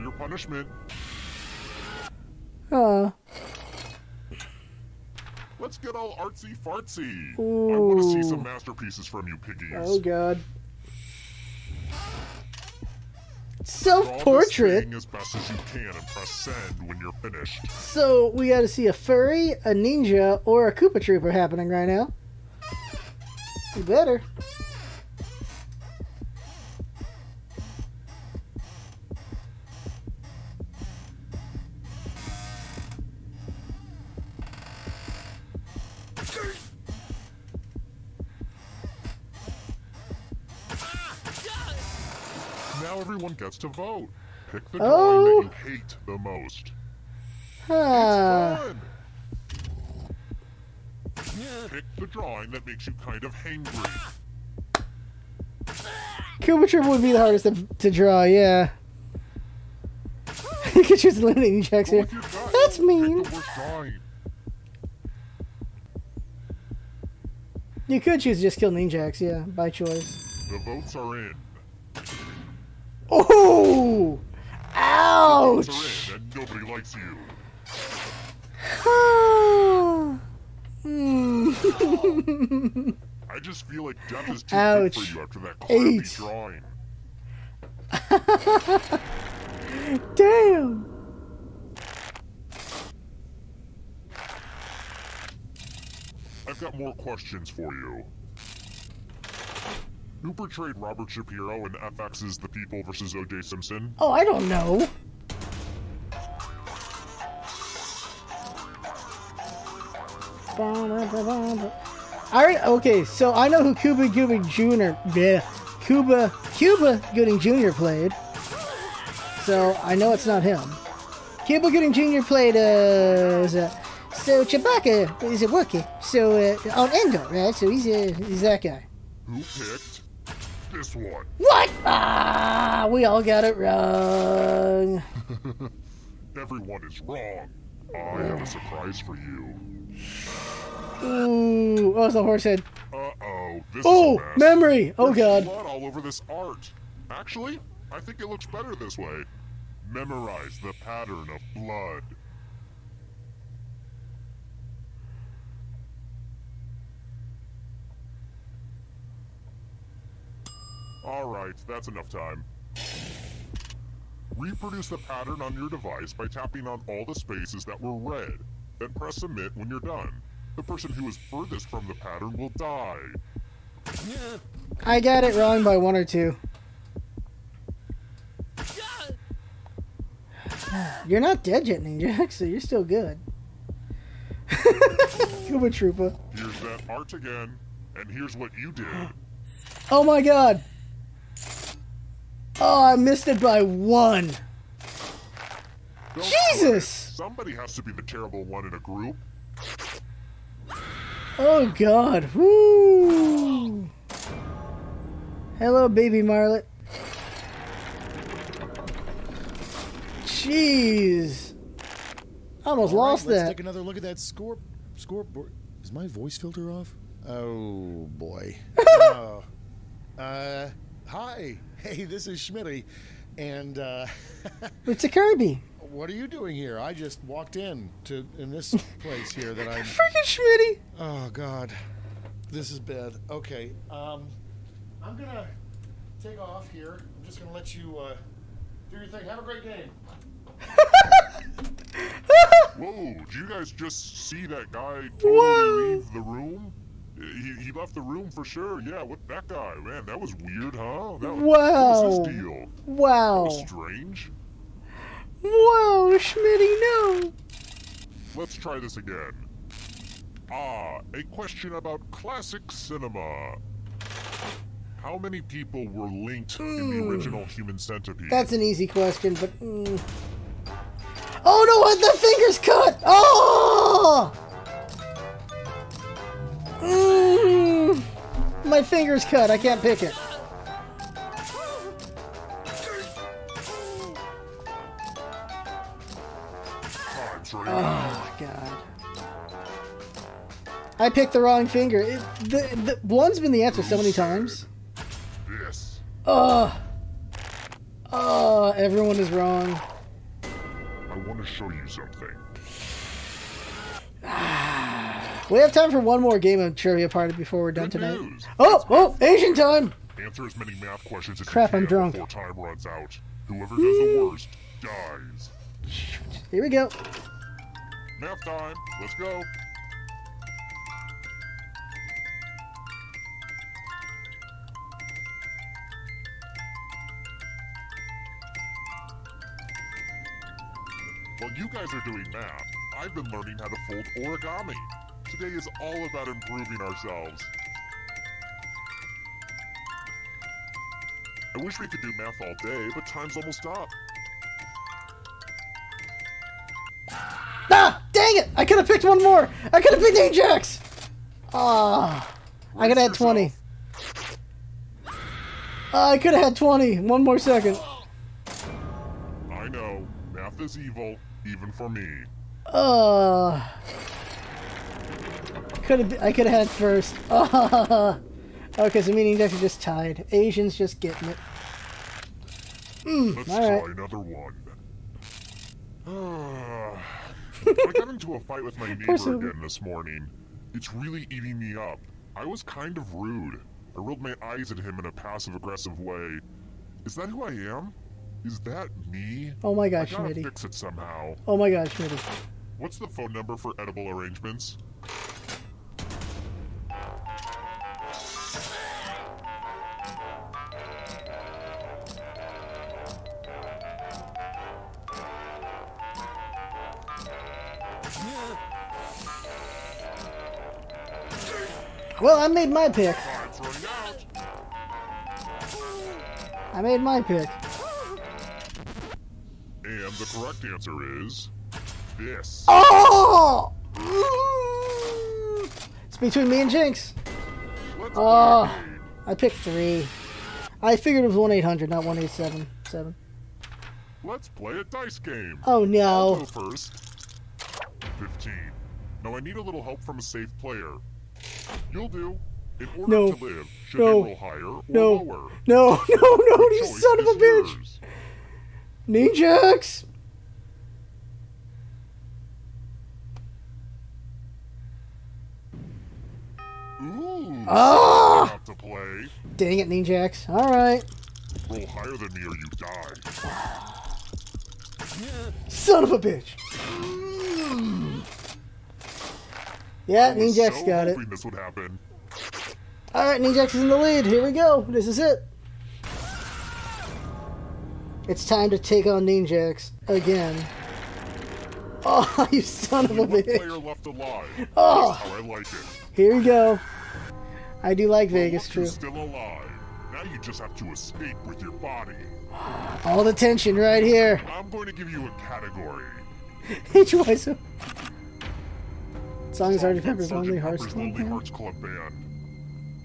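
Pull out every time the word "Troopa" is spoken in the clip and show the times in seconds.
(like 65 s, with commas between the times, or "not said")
20 s, 185 s.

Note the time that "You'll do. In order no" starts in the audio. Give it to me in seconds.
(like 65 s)
441 s.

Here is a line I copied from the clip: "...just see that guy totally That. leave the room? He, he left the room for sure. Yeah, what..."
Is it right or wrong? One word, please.
wrong.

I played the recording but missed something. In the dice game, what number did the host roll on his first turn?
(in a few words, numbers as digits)
15.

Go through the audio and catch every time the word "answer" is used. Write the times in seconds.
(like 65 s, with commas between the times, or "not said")
293 s, 310 s, 420 s.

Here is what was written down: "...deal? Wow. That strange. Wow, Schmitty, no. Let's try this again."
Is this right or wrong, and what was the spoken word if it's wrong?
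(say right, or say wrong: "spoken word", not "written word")
right.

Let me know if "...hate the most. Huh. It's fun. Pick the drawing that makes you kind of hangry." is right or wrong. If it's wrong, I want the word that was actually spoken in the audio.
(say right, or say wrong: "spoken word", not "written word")
right.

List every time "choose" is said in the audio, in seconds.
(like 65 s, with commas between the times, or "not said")
60 s, 68 s.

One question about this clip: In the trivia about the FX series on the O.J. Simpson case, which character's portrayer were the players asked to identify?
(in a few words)
Robert Shapiro.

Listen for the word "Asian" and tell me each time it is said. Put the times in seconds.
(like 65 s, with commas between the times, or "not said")
309 s, 370 s.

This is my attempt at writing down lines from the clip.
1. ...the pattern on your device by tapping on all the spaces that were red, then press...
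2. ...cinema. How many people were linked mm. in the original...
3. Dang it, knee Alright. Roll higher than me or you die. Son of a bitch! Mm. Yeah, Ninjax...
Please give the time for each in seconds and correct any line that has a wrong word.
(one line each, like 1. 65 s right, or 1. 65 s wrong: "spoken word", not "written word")
1. 164 s right
2. 262 s right
3. 459 s right.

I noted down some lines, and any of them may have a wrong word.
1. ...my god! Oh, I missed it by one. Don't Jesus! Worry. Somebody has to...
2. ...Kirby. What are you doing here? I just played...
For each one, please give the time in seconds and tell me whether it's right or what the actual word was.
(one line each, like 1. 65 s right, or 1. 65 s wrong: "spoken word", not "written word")
1. 190 s right
2. 225 s wrong: "walked", not "played".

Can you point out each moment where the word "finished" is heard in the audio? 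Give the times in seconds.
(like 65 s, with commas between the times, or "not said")
17 s.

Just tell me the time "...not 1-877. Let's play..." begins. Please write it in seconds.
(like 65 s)
431 s.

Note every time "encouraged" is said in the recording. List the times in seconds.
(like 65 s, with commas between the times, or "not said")
not said.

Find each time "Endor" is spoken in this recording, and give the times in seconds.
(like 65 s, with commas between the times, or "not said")
126 s.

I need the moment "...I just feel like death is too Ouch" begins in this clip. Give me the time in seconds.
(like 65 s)
83 s.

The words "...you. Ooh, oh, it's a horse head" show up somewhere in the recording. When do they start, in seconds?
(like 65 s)
139 s.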